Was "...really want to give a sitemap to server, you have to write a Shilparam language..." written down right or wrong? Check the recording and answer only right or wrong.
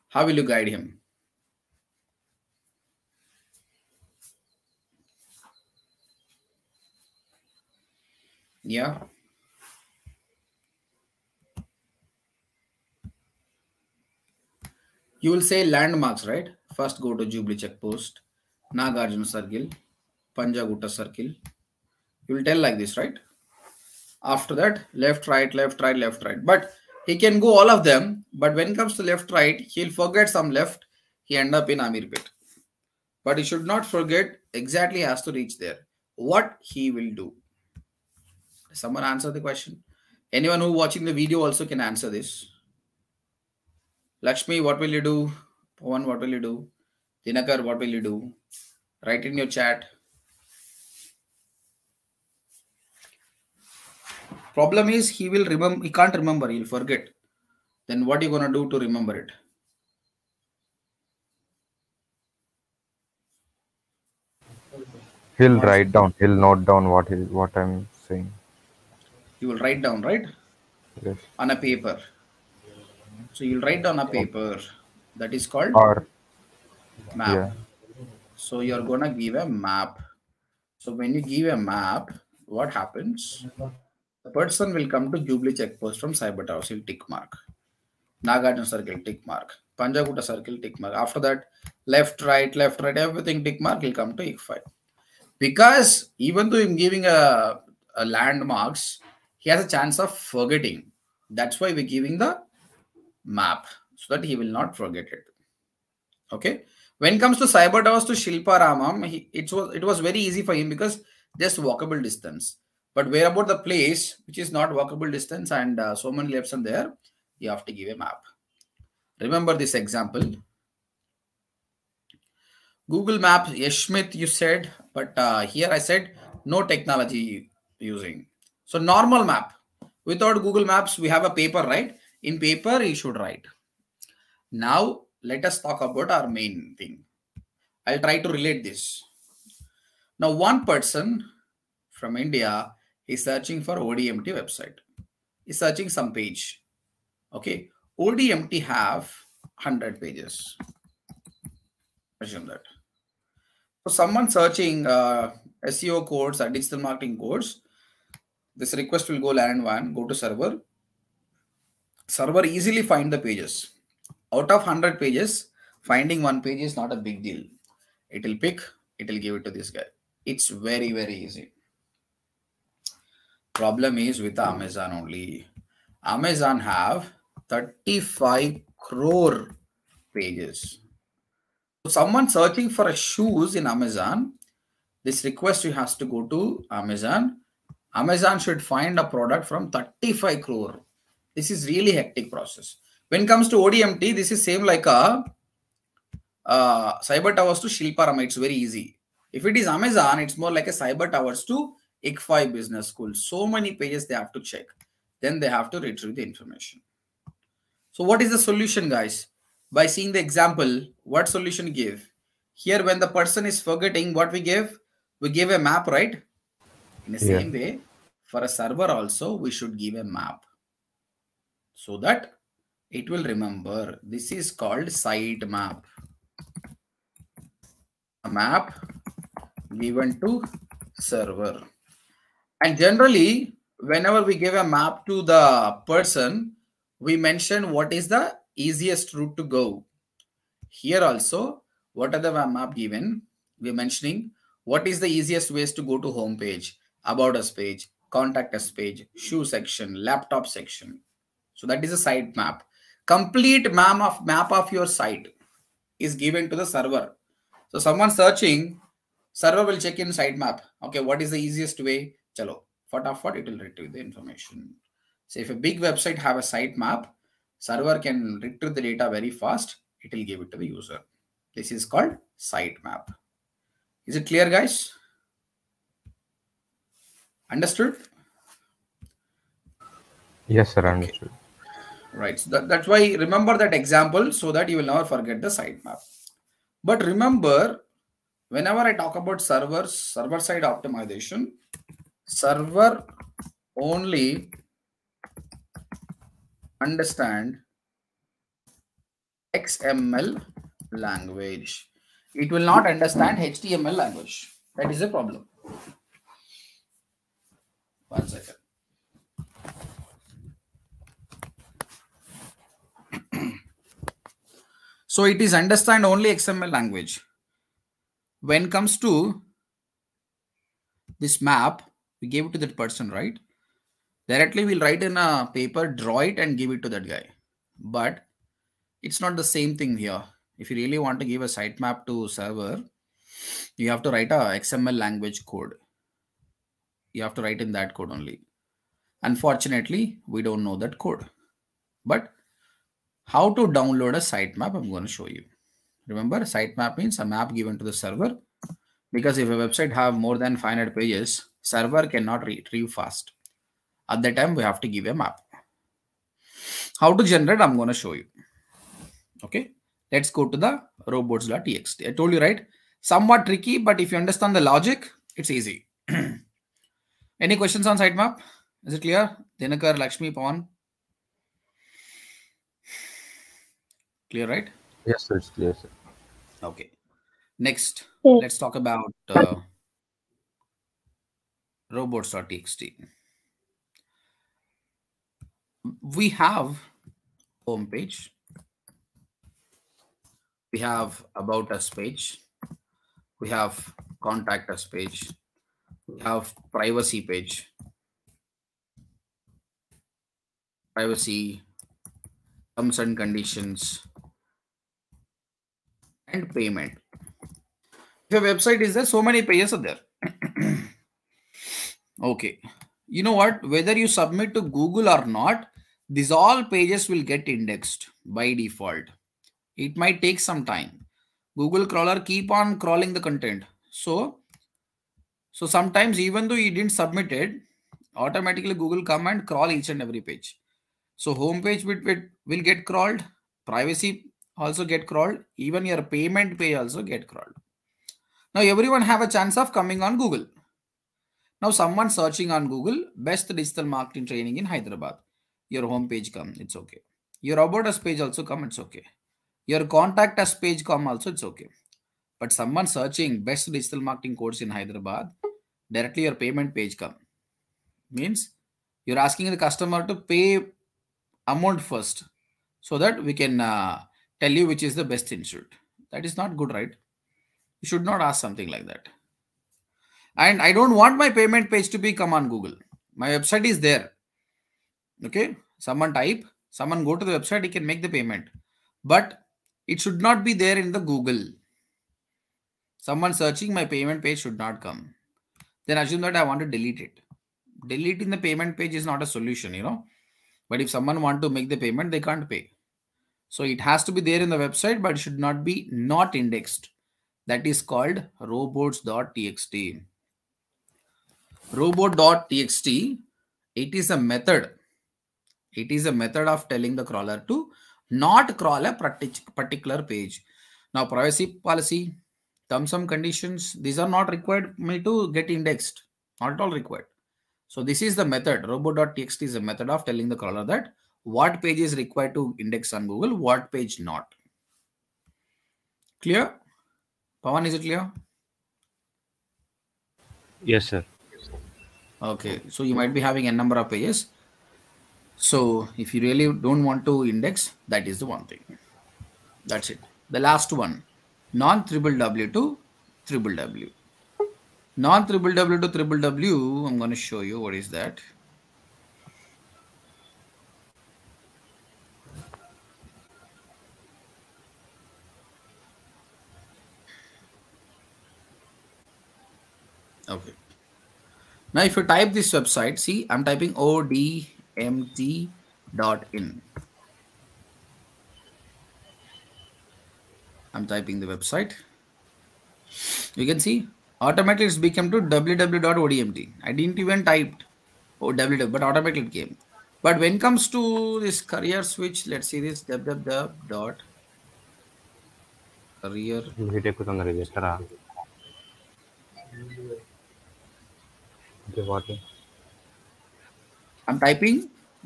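wrong.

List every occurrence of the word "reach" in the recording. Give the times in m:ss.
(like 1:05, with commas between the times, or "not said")
0:35.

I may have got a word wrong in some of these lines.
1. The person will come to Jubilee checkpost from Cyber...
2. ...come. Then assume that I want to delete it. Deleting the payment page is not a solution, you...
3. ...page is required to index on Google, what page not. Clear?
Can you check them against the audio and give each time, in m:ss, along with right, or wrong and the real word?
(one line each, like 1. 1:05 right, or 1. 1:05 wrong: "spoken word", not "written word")
1. 1:24 right
2. 8:04 right
3. 8:41 right.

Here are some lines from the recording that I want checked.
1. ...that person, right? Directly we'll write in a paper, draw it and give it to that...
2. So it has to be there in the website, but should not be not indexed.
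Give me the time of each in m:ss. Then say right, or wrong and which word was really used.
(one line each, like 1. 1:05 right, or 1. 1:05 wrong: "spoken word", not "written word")
1. 5:22 right
2. 8:13 right.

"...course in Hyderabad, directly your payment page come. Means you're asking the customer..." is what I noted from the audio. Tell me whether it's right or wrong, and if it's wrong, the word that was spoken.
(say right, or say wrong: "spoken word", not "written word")
right.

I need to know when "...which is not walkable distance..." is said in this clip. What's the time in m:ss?
1:54.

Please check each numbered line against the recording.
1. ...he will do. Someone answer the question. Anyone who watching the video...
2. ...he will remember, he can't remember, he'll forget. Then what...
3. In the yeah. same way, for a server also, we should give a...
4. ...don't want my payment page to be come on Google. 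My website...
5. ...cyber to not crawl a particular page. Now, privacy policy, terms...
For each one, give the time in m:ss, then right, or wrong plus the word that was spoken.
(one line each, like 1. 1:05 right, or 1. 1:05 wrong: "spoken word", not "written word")
1. 0:36 right
2. 0:55 right
3. 3:37 right
4. 7:50 right
5. 8:27 wrong: "crawler", not "cyber".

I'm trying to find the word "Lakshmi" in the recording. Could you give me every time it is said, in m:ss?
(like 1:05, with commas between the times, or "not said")
0:44, 6:09.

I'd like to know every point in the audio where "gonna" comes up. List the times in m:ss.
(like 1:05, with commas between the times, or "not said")
0:58, 1:18.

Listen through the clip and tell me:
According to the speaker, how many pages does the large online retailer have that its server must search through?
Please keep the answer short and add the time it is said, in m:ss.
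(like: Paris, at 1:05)
35 crore, at 2:57.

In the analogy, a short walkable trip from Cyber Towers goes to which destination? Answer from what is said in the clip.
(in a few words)
Shilparamam.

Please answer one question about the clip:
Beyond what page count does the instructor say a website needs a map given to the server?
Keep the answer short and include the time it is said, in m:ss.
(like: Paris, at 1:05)
500, at 5:50.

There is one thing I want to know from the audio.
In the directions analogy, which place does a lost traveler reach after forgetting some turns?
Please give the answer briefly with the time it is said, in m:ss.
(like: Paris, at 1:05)
Amirpet, at 0:31.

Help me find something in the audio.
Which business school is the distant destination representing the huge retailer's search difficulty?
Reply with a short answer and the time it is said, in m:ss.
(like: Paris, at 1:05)
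ICFAI business school, at 3:22.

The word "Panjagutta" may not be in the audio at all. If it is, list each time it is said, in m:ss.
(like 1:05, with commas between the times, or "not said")
0:20, 1:29.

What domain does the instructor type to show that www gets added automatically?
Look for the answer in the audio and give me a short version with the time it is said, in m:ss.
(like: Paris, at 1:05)
odmt.in, at 9:23.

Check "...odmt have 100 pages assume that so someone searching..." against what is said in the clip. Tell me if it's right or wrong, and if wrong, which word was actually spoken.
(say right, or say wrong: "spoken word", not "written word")
right.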